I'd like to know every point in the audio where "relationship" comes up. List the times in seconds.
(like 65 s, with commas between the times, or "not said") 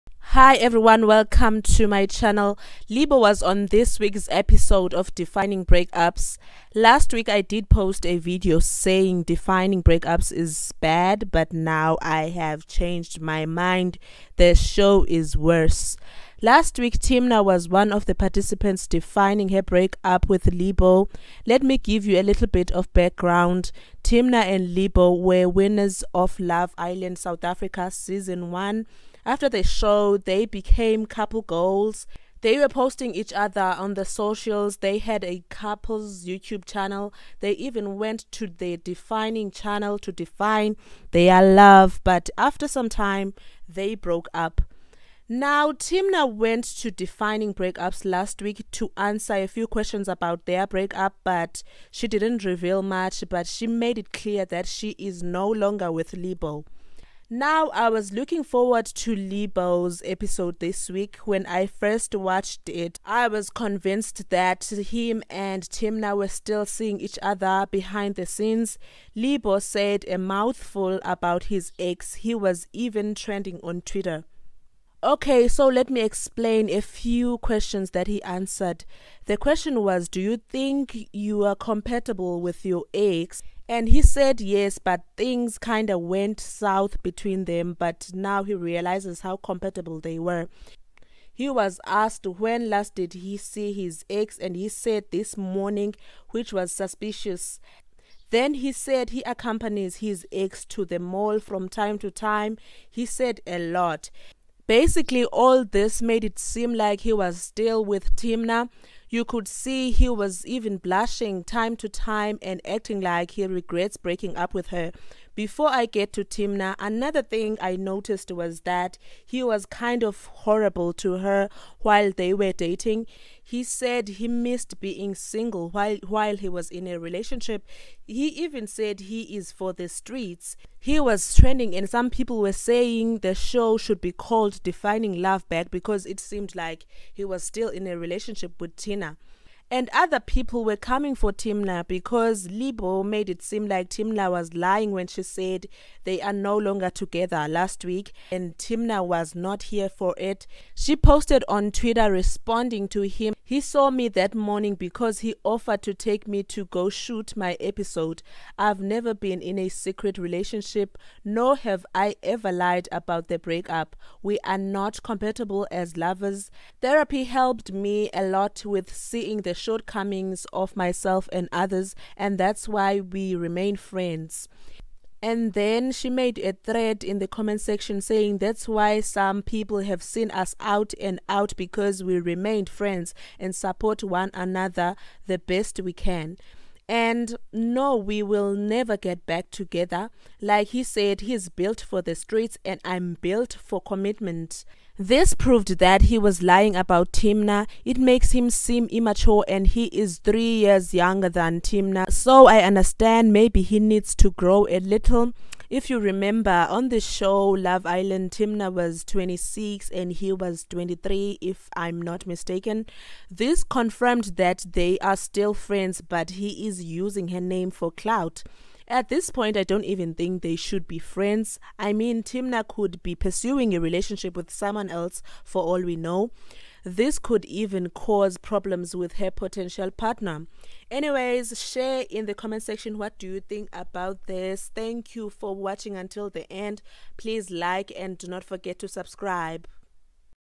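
126 s, 137 s, 160 s, 223 s.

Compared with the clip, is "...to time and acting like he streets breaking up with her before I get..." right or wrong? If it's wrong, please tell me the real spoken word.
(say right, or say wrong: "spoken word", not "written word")
wrong: "regrets", not "streets".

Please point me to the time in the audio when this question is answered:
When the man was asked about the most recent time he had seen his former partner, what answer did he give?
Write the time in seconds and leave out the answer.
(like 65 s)
95 s.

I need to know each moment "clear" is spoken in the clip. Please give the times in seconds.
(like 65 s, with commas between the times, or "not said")
54 s.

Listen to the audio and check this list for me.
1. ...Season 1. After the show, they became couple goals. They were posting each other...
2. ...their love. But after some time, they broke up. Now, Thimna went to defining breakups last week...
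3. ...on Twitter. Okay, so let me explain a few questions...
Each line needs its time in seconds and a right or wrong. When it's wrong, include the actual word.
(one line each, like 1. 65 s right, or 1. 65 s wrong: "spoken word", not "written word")
1. 27 s right
2. 41 s right
3. 73 s right.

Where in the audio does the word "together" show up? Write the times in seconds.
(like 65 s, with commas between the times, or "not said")
146 s, 189 s.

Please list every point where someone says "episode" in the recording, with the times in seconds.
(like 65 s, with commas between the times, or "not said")
4 s, 60 s, 157 s.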